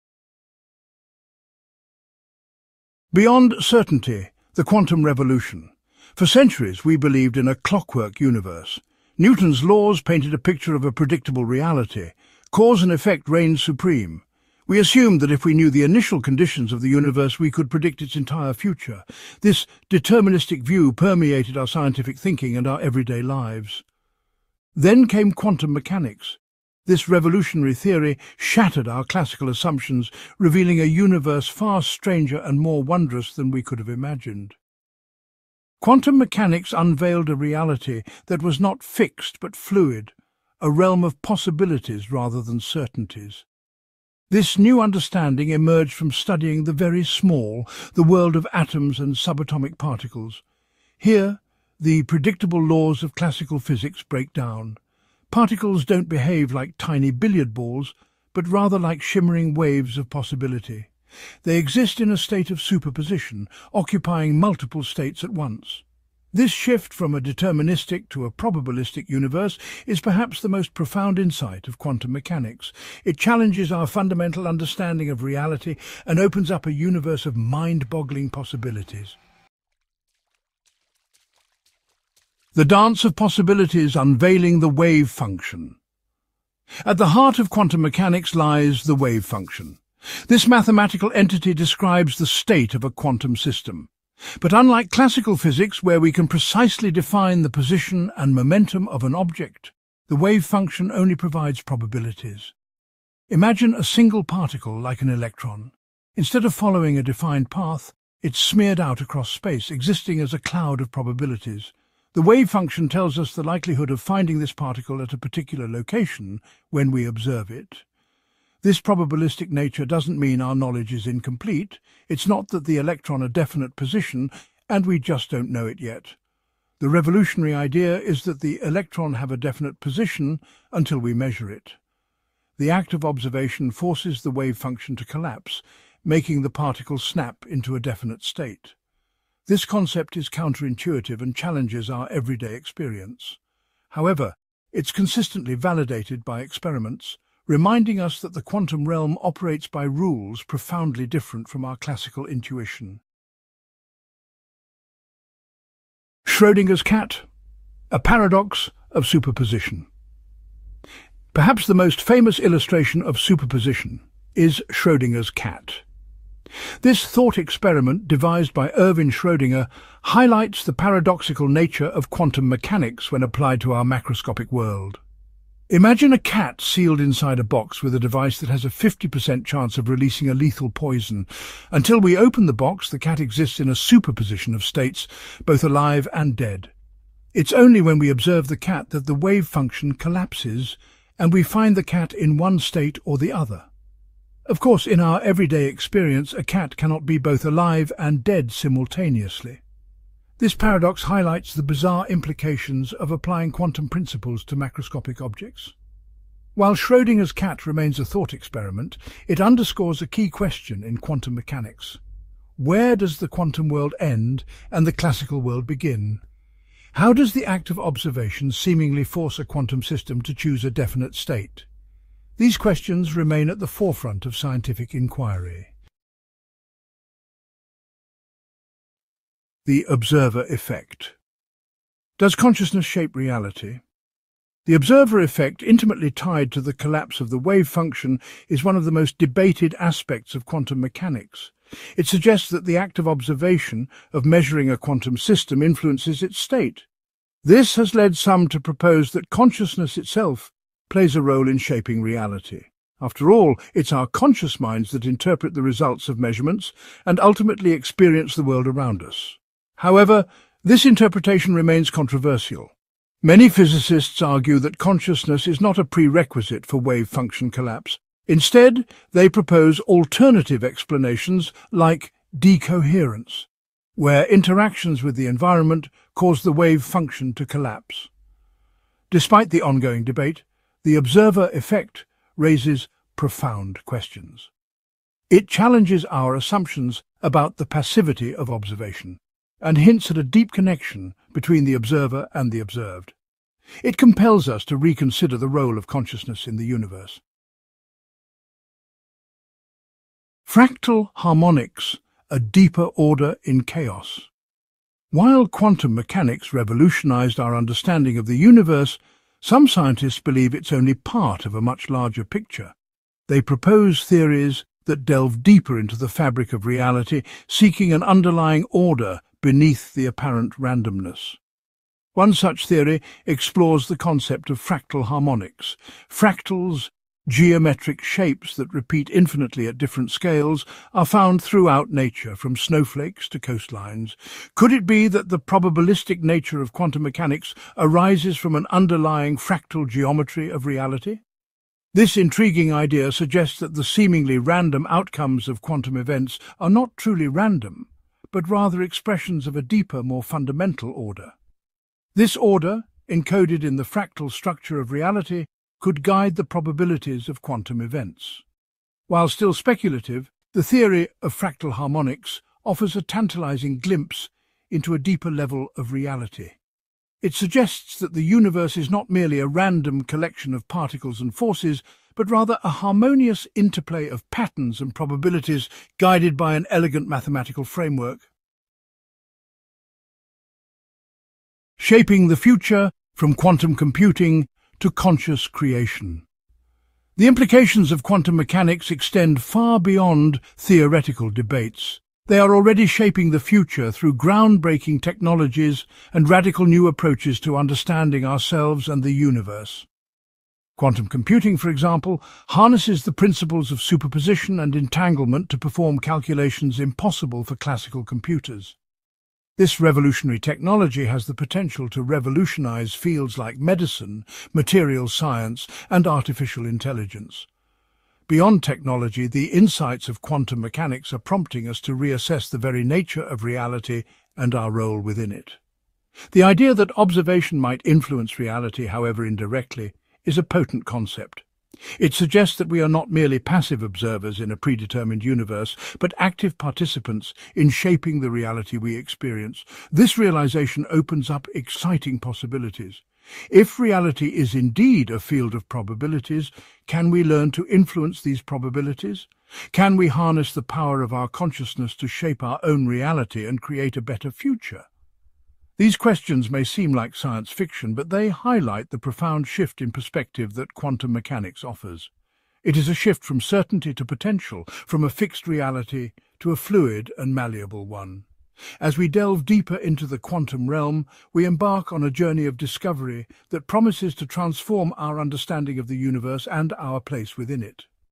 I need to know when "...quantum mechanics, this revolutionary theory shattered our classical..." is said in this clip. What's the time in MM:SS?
00:25.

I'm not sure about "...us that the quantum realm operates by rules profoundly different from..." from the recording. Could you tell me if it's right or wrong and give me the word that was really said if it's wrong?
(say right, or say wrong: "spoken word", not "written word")
right.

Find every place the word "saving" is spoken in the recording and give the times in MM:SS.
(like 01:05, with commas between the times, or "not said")
not said.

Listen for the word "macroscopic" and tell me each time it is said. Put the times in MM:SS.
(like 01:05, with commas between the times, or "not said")
02:53, 03:24.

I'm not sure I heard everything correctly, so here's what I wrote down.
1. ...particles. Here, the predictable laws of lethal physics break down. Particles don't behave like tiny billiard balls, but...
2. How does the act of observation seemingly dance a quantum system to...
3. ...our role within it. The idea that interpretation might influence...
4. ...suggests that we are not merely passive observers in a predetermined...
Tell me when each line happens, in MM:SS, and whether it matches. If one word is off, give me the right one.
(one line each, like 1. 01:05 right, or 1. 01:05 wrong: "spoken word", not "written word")
1. 00:49 wrong: "classical", not "lethal"
2. 03:36 wrong: "force", not "dance"
3. 07:04 wrong: "observation", not "interpretation"
4. 07:12 right.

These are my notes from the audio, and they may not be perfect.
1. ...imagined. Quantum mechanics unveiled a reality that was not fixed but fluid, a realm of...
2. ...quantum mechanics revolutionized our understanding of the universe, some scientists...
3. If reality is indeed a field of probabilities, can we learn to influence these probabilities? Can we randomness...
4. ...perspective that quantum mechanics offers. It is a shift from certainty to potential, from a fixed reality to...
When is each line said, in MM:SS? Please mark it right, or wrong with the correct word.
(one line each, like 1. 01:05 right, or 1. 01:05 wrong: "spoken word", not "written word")
1. 00:33 right
2. 05:05 right
3. 07:23 wrong: "harness", not "randomness"
4. 07:39 right.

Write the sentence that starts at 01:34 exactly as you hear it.
But unlike classical physics, where we can precisely define the position and momentum of an object, the wave function only provides probabilities.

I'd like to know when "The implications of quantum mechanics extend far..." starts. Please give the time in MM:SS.
06:27.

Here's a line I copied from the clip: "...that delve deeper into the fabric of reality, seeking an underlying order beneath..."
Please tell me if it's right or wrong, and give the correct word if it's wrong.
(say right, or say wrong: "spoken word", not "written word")
right.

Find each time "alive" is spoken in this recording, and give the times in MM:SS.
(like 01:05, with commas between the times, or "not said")
03:05, 03:17.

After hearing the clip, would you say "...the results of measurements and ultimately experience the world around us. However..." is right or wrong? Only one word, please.
right.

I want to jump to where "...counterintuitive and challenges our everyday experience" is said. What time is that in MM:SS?
02:20.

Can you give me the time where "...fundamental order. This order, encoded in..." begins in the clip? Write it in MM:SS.
05:50.